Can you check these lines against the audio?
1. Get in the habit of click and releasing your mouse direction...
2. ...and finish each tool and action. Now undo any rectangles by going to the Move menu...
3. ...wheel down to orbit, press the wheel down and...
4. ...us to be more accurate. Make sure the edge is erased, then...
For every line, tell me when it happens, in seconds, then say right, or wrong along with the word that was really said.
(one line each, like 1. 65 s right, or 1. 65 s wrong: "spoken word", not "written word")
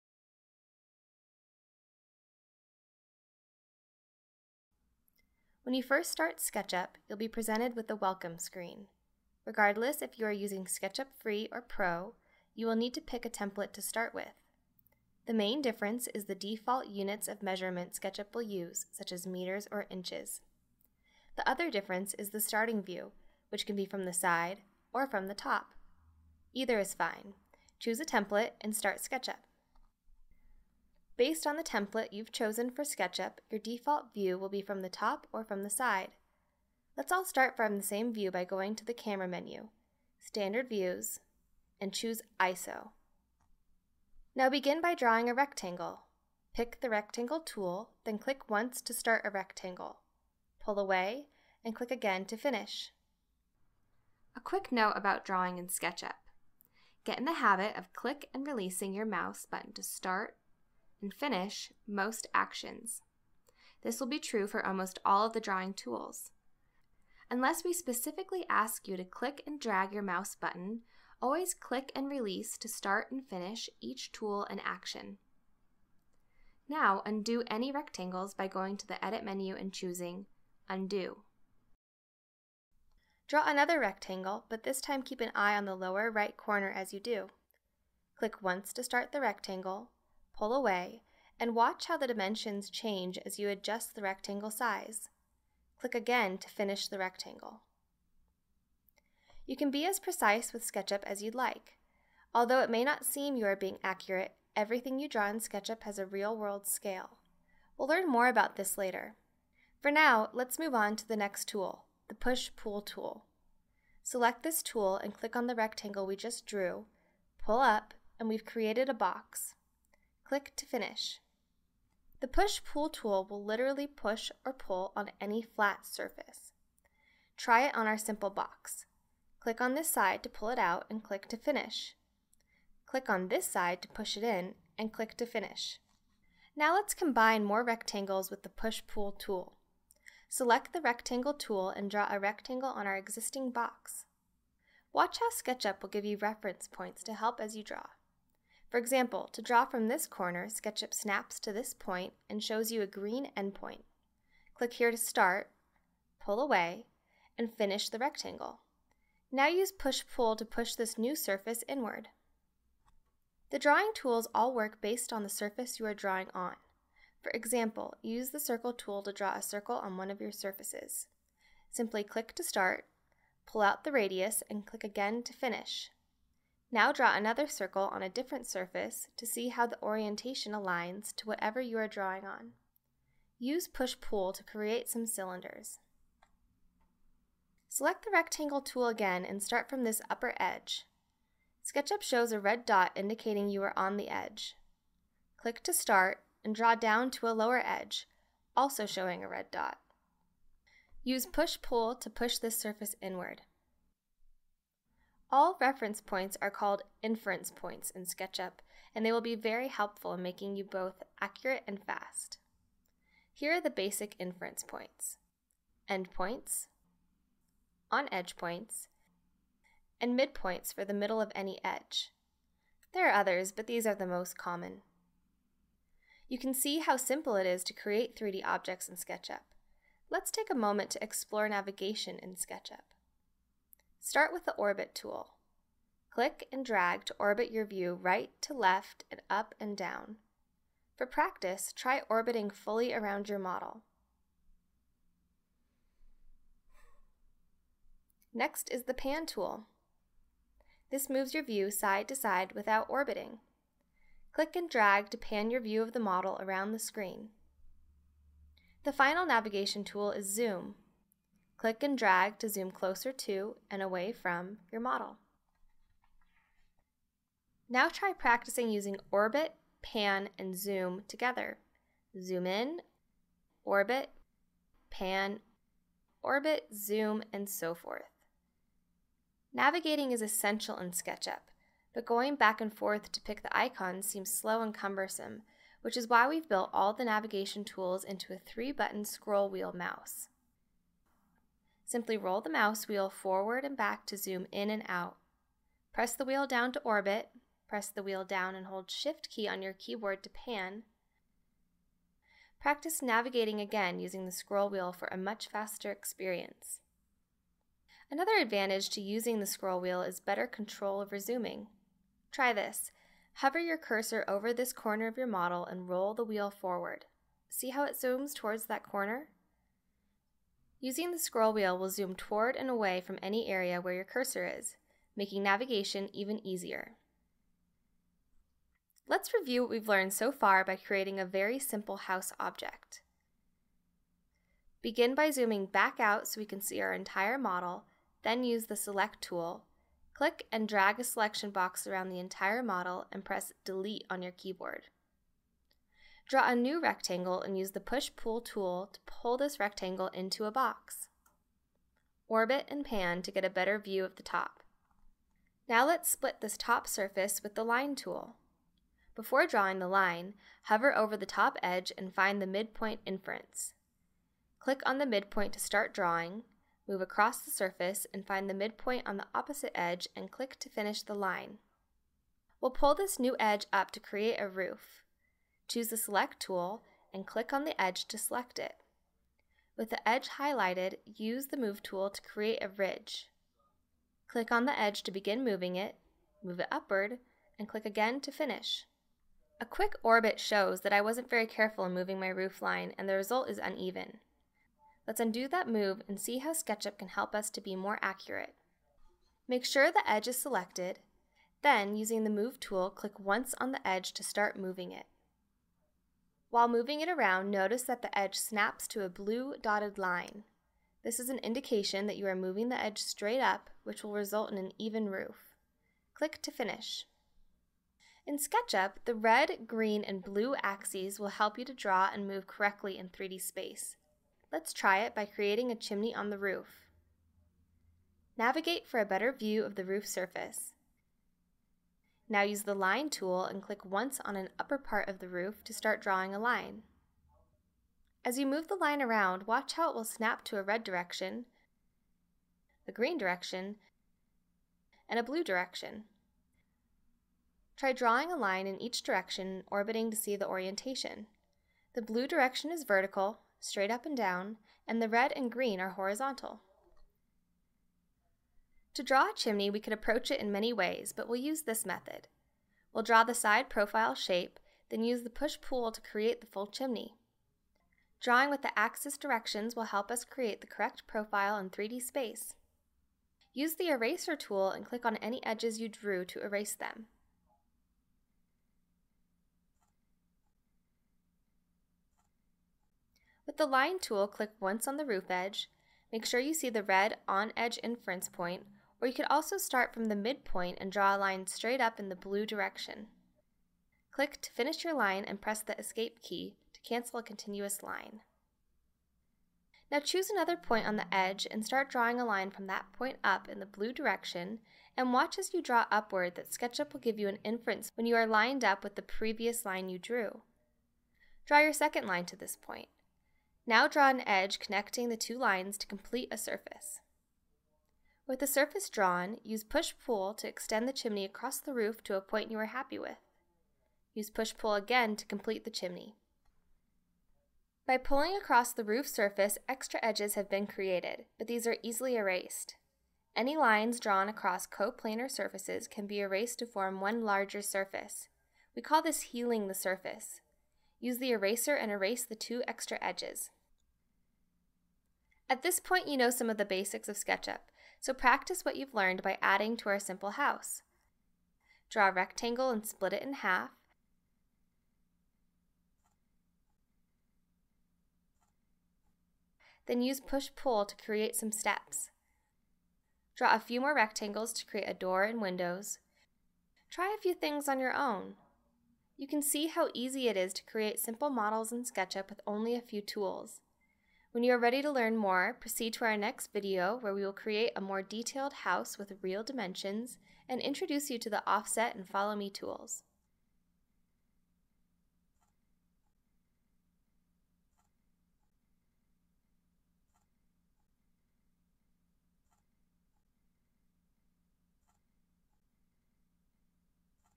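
1. 57 s wrong: "button", not "direction"
2. 73 s wrong: "Edit", not "Move"
3. 296 s right
4. 397 s wrong: "selected", not "erased".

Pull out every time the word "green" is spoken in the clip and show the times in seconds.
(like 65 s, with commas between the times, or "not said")
152 s, 419 s, 442 s, 455 s.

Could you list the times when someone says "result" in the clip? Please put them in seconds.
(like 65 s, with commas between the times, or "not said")
393 s, 414 s.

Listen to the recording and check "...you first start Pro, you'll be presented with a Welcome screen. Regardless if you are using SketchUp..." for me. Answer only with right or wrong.
wrong.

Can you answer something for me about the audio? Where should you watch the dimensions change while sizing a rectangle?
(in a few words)
Lower right corner.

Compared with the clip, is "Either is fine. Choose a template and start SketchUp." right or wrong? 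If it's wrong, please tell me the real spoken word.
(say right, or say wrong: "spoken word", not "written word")
right.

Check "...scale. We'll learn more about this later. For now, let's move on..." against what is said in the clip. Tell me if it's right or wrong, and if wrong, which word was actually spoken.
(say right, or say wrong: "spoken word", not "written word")
right.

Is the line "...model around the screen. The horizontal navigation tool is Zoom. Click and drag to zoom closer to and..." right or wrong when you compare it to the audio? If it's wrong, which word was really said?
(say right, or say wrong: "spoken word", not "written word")
wrong: "final", not "horizontal".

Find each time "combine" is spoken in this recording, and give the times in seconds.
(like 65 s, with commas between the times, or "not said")
136 s.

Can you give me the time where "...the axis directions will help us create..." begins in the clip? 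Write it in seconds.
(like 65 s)
468 s.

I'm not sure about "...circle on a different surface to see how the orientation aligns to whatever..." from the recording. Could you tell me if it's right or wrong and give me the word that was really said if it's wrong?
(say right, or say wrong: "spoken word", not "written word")
right.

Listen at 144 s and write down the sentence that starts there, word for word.
Watch how SketchUp will give you reference points to help as you draw.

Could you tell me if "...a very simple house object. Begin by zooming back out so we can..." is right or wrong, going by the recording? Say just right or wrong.
right.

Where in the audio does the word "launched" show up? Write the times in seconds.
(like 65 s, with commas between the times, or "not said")
not said.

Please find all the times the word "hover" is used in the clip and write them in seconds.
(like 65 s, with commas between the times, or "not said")
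313 s, 360 s.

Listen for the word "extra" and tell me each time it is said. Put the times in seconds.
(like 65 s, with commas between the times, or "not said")
529 s, 542 s.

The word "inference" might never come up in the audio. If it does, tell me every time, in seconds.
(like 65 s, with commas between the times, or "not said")
207 s, 214 s, 363 s, 487 s, 507 s.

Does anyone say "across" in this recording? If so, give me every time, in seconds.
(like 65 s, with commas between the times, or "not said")
367 s, 521 s, 528 s, 534 s.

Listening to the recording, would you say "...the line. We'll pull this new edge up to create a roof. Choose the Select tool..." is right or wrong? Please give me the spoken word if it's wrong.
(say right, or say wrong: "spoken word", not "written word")
right.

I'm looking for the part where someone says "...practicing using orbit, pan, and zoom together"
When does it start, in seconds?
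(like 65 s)
268 s.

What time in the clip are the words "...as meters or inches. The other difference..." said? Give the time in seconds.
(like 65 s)
19 s.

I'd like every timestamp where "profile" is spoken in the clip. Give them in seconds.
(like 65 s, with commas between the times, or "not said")
463 s, 471 s.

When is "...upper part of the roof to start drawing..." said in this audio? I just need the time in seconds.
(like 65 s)
434 s.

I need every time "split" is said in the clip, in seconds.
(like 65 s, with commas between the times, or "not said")
356 s, 552 s.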